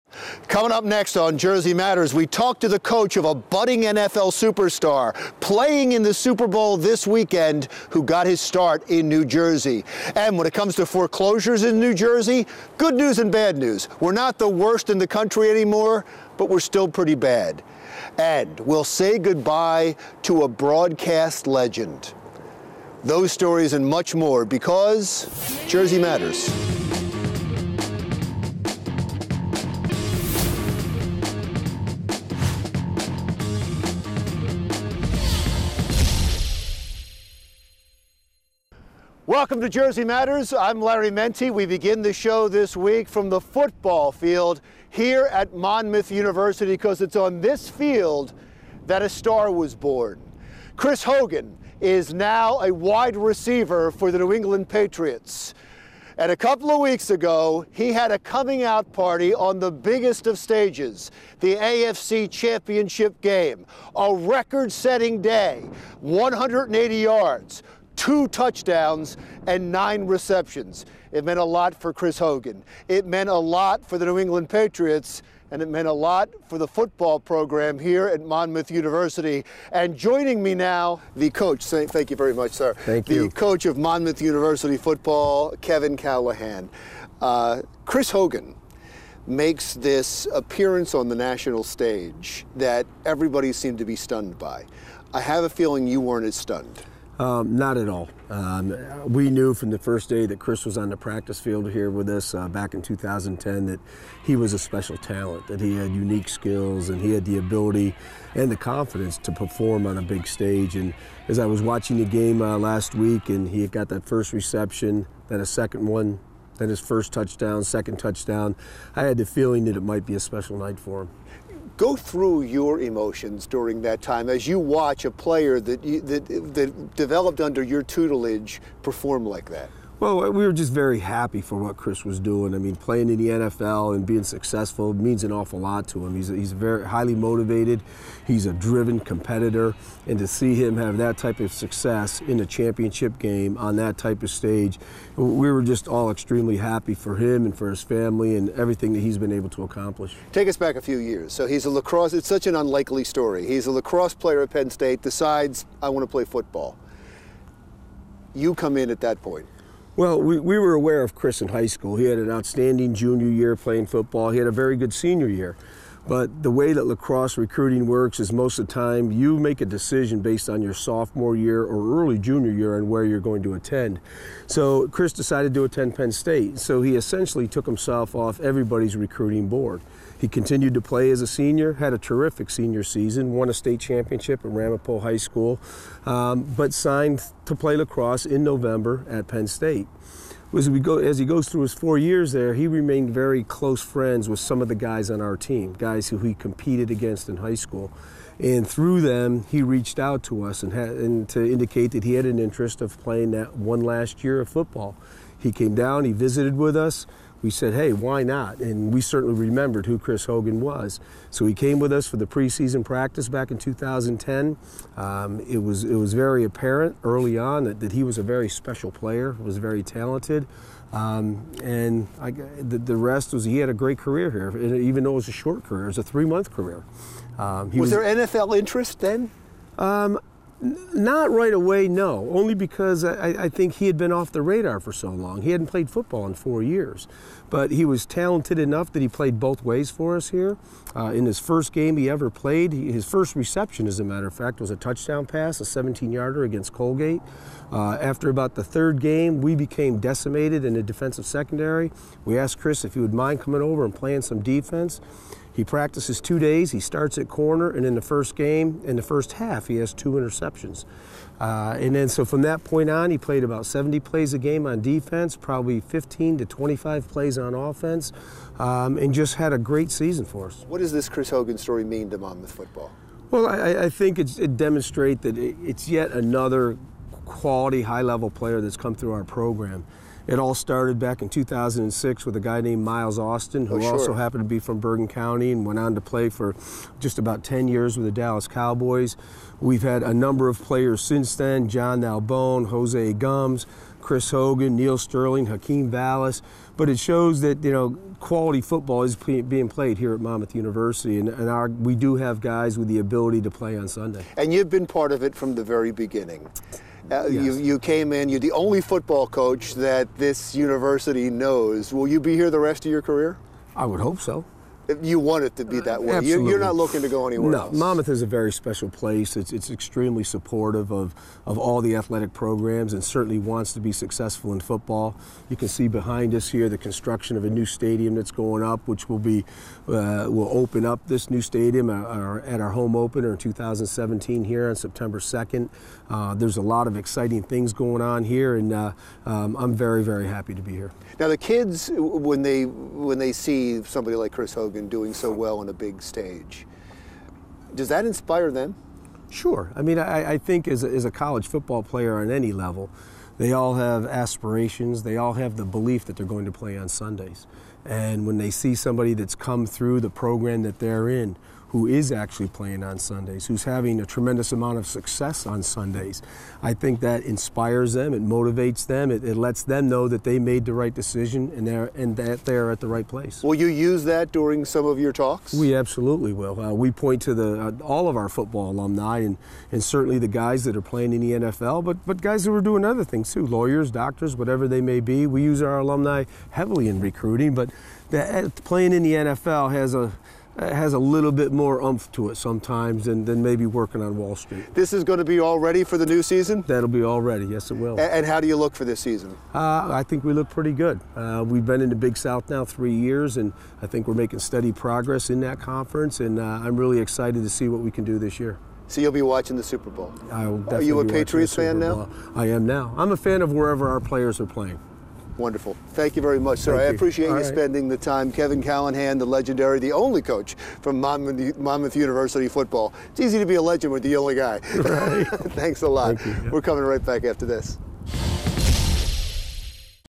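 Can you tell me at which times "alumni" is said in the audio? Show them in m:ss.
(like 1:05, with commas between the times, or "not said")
6:18, 6:25.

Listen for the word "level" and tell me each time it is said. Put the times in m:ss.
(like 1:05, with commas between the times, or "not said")
4:38, 5:52.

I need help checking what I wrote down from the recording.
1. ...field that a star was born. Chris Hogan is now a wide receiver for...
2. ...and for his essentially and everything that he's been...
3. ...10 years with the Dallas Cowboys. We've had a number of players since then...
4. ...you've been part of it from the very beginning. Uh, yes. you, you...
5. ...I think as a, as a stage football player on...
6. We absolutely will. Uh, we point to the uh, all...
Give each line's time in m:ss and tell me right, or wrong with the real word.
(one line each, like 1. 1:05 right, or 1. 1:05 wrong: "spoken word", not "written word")
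1. 0:47 right
2. 2:27 wrong: "family", not "essentially"
3. 4:47 right
4. 5:04 right
5. 5:50 wrong: "college", not "stage"
6. 6:15 right.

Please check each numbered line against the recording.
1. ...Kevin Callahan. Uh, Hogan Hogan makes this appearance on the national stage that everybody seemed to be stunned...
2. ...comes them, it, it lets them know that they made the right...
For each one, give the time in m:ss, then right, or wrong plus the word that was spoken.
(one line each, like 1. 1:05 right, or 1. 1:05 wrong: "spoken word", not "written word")
1. 1:25 wrong: "Chris", not "Hogan"
2. 6:08 wrong: "motivates", not "comes".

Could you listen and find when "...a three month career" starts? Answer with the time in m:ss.
3:45.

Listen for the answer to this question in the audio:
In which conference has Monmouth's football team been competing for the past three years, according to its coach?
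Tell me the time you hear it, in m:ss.
6:41.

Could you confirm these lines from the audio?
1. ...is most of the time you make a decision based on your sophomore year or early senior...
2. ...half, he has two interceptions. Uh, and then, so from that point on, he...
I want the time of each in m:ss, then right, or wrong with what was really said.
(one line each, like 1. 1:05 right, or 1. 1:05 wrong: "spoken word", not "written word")
1. 2:48 wrong: "junior", not "senior"
2. 4:19 right.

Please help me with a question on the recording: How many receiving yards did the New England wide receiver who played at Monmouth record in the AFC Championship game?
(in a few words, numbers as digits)
180 yards.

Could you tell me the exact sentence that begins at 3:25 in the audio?
He came down, he visited with us we said, hey, why not?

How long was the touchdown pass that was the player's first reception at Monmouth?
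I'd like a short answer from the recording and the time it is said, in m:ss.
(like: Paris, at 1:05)
17 yards, at 4:05.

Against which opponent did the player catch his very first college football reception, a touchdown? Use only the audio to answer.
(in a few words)
Colgate.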